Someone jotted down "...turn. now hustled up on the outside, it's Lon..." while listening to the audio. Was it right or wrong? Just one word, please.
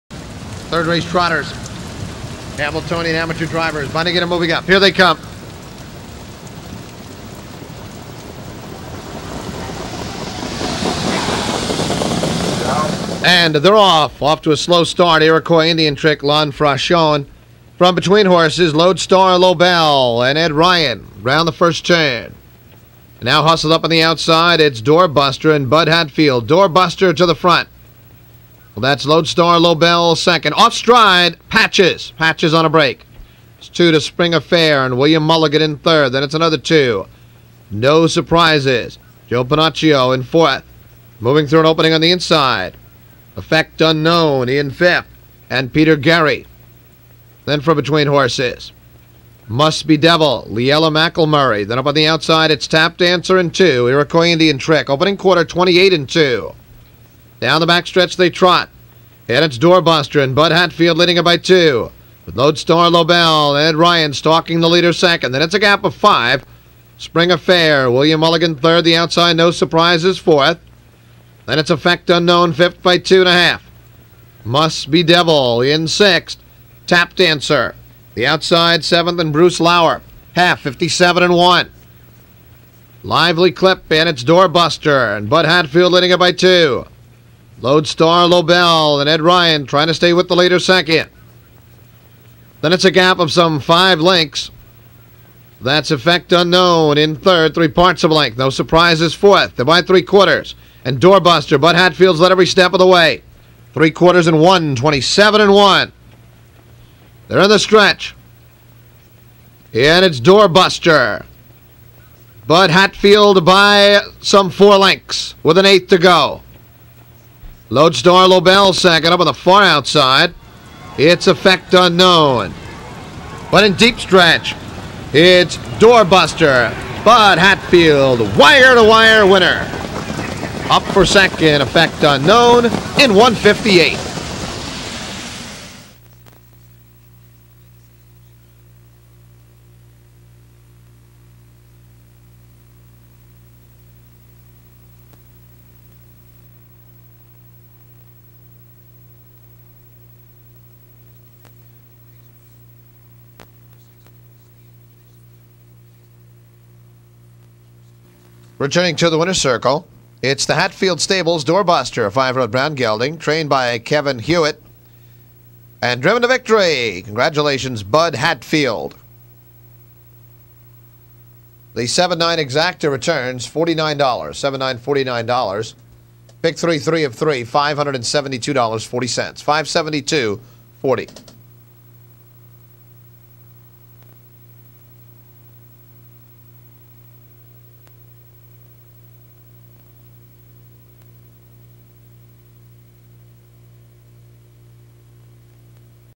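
wrong.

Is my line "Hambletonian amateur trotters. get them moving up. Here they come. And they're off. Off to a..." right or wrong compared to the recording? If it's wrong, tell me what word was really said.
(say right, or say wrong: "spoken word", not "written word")
wrong: "drivers", not "trotters".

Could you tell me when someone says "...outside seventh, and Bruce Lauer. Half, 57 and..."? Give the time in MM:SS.
01:18.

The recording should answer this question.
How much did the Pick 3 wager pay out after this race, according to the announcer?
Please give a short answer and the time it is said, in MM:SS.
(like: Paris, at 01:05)
$572.40, at 02:57.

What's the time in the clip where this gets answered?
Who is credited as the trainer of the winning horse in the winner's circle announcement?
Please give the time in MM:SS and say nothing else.
02:43.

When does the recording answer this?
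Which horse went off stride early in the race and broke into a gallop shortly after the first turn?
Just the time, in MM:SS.
00:32.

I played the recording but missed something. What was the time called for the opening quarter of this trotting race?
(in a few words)
28 and two.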